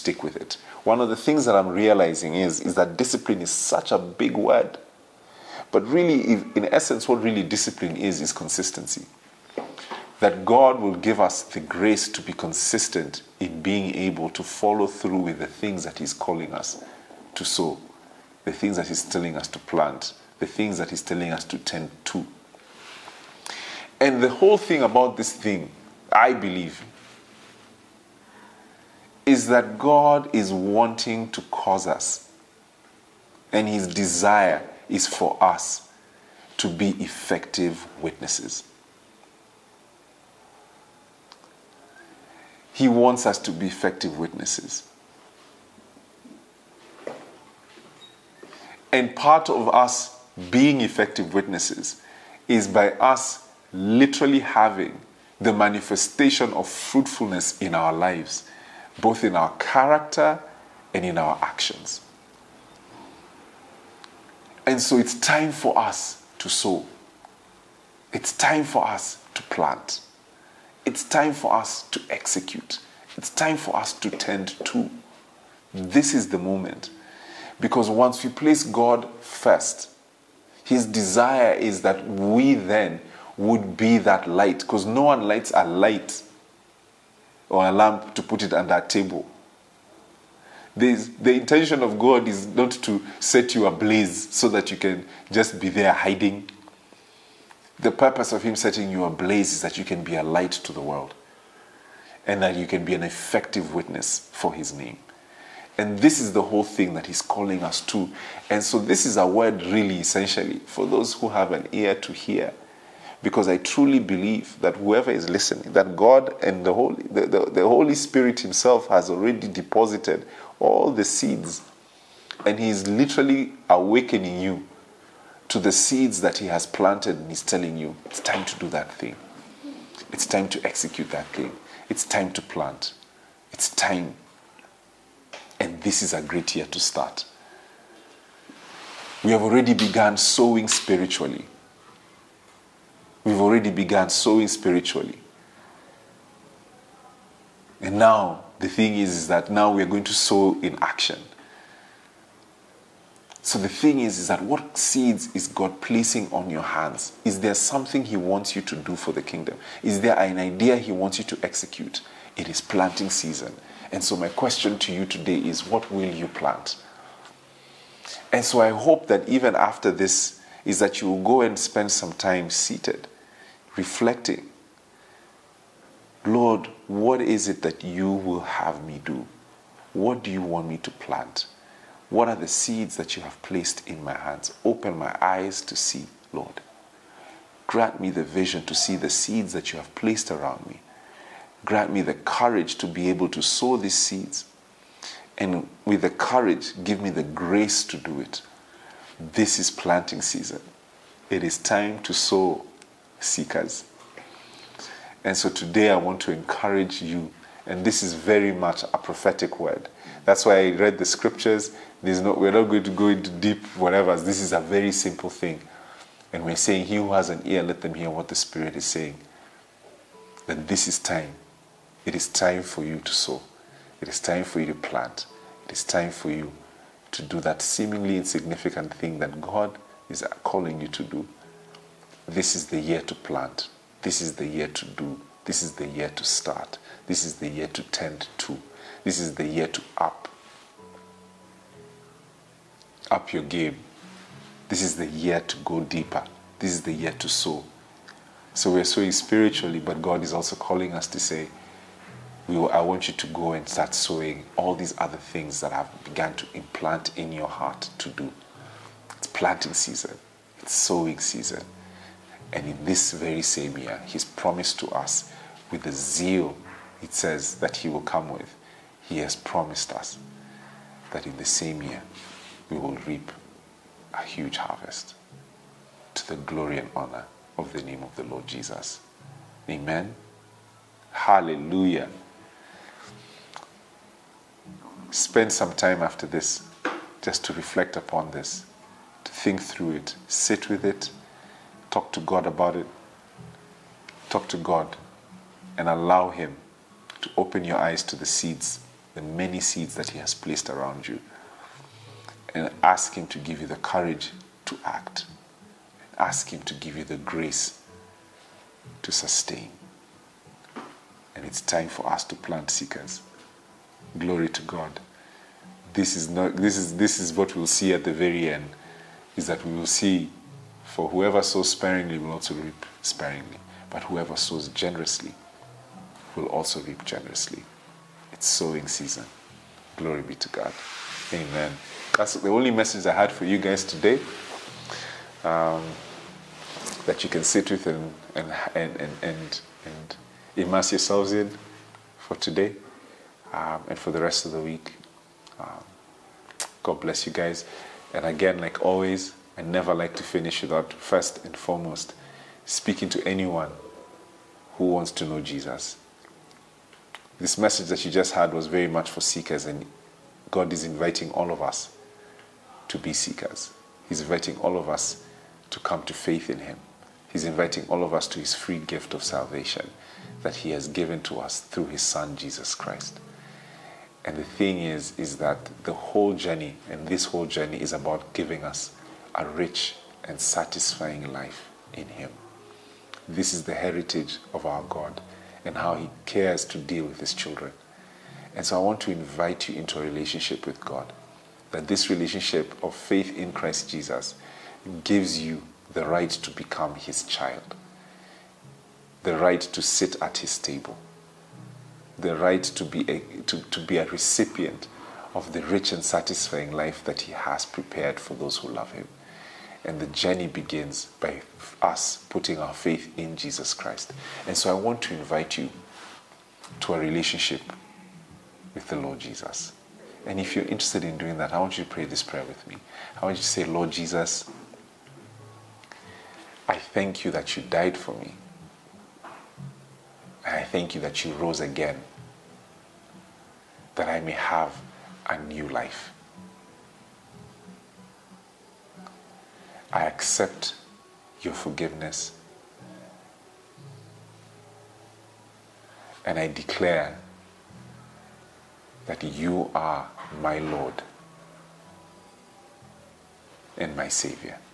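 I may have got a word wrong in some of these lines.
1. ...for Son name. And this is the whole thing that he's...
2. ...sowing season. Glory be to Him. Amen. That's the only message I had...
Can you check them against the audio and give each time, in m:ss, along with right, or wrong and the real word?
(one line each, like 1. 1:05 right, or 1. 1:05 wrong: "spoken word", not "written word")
1. 1:44 wrong: "His", not "Son"
2. 5:28 wrong: "God", not "Him".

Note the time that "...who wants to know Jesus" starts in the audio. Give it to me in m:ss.
5:54.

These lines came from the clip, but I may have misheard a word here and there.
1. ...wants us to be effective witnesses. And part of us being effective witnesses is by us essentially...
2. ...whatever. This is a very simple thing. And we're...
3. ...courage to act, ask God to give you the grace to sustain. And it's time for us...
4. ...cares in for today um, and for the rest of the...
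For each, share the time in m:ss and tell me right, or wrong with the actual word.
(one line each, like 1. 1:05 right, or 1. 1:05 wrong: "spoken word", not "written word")
1. 0:42 wrong: "literally", not "essentially"
2. 3:33 right
3. 5:03 wrong: "Him", not "God"
4. 5:40 wrong: "yourselves", not "cares".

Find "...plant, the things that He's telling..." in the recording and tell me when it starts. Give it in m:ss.
0:19.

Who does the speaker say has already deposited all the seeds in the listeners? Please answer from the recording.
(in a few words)
The Holy Spirit.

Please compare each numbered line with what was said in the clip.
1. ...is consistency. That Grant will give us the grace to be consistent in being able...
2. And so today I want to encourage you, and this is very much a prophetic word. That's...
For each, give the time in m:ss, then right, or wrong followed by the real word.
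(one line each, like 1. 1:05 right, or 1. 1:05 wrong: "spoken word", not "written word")
1. 0:08 wrong: "God", not "Grant"
2. 3:25 right.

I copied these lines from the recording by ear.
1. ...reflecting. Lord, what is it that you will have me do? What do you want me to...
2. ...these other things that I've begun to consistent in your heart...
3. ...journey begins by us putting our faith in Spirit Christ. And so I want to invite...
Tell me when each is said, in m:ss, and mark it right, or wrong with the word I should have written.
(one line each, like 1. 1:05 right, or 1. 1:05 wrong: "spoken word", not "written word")
1. 2:53 right
2. 4:14 wrong: "implant", not "consistent"
3. 6:50 wrong: "Jesus", not "Spirit".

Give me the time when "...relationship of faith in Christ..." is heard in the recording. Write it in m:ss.
6:32.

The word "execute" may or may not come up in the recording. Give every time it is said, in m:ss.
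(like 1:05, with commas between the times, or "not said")
1:12, 2:10, 2:41.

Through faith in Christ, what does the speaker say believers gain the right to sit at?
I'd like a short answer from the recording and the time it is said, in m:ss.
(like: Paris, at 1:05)
His table, at 6:40.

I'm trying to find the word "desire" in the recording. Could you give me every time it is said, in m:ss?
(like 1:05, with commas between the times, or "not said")
0:33, 1:20.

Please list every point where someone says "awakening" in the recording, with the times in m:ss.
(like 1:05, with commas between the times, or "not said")
2:03.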